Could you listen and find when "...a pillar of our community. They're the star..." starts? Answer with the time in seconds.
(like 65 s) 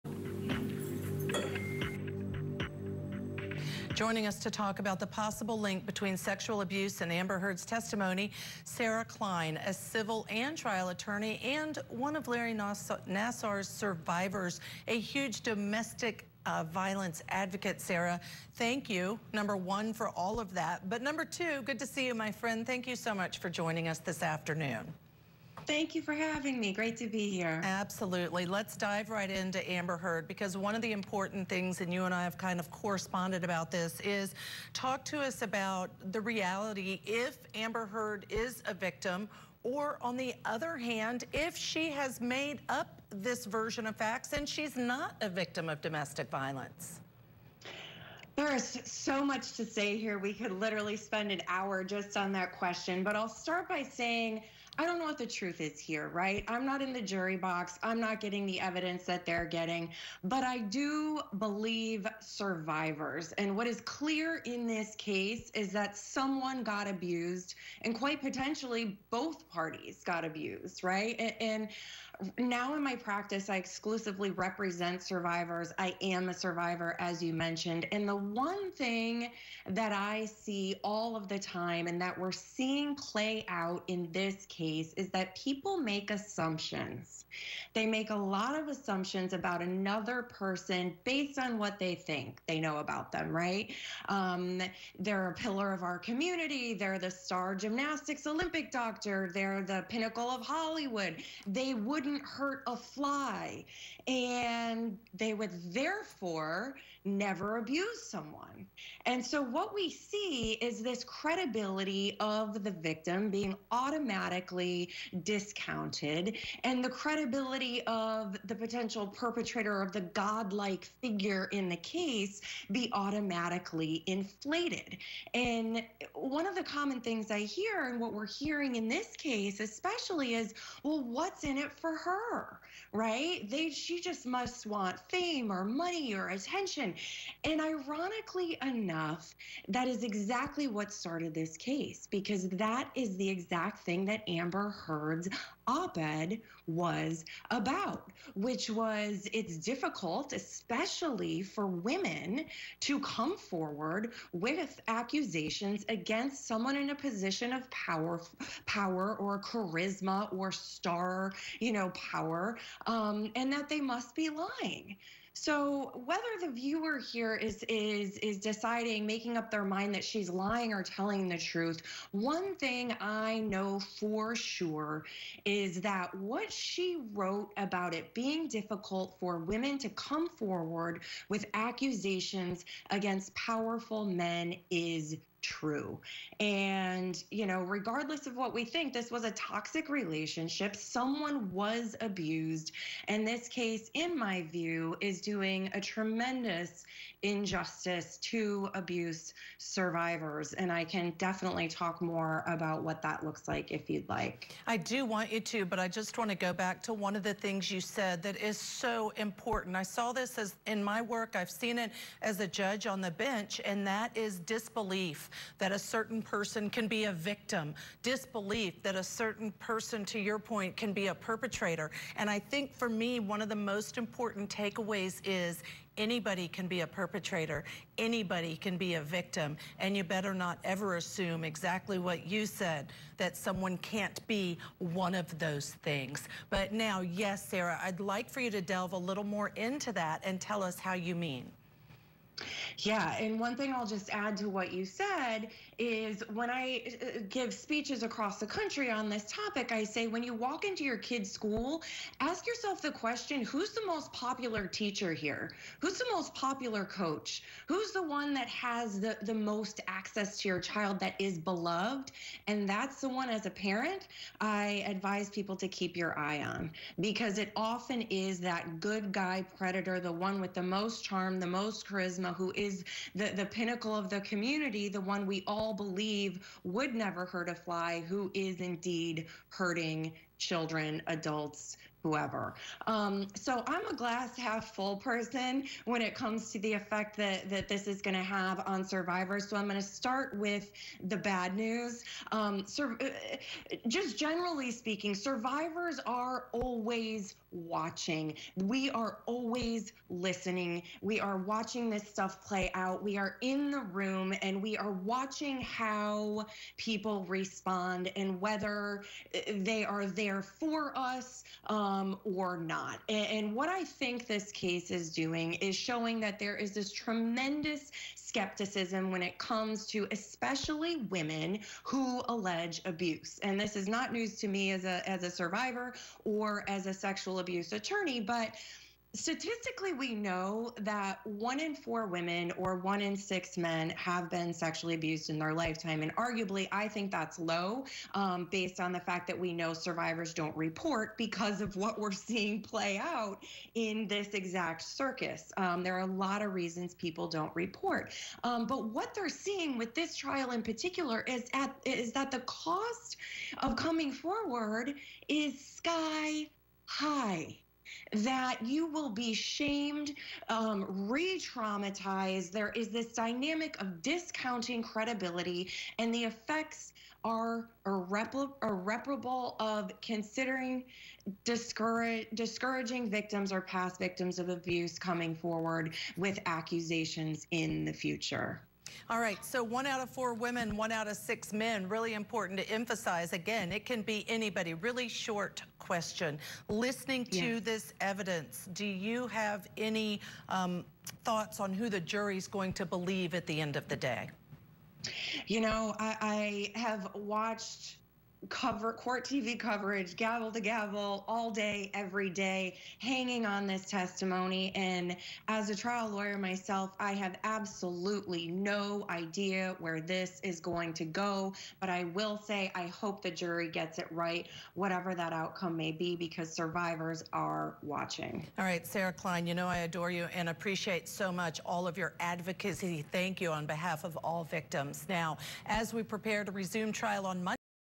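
95 s.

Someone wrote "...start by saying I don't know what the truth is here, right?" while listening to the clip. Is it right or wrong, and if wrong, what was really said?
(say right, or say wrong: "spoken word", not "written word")
right.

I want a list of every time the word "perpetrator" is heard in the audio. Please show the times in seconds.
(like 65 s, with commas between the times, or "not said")
119 s, 221 s, 226 s.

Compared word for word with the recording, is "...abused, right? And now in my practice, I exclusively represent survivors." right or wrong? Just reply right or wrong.
right.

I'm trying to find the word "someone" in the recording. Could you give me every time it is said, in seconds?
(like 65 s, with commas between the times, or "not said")
65 s, 108 s, 156 s, 190 s, 233 s.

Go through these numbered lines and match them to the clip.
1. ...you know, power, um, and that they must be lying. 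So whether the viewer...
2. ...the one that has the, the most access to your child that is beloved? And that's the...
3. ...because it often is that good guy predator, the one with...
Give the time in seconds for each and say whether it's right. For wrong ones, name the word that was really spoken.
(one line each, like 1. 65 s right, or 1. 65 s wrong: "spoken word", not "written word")
1. 161 s right
2. 257 s right
3. 266 s right.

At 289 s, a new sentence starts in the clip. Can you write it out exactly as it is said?
So I'm going to start with the bad news.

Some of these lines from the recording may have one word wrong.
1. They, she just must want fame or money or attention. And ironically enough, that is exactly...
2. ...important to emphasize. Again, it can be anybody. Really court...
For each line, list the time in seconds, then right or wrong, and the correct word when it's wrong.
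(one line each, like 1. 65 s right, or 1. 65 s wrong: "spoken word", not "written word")
1. 133 s right
2. 382 s wrong: "short", not "court".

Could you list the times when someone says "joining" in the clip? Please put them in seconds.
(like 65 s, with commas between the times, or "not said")
3 s, 23 s.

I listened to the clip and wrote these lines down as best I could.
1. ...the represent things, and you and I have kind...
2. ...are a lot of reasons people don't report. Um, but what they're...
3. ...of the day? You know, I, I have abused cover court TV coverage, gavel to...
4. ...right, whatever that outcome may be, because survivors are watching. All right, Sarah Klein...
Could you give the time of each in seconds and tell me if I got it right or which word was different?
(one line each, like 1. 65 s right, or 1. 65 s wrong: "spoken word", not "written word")
1. 30 s wrong: "important", not "represent"
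2. 345 s right
3. 393 s wrong: "watched", not "abused"
4. 414 s right.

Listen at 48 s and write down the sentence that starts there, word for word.
There is so much to say here.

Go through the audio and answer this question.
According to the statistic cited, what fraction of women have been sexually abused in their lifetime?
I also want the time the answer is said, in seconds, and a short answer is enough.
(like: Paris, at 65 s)
1 in 4, at 331 s.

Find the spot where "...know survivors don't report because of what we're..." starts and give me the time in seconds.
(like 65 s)
339 s.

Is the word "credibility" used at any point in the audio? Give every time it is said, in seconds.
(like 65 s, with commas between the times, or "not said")
111 s, 116 s, 364 s.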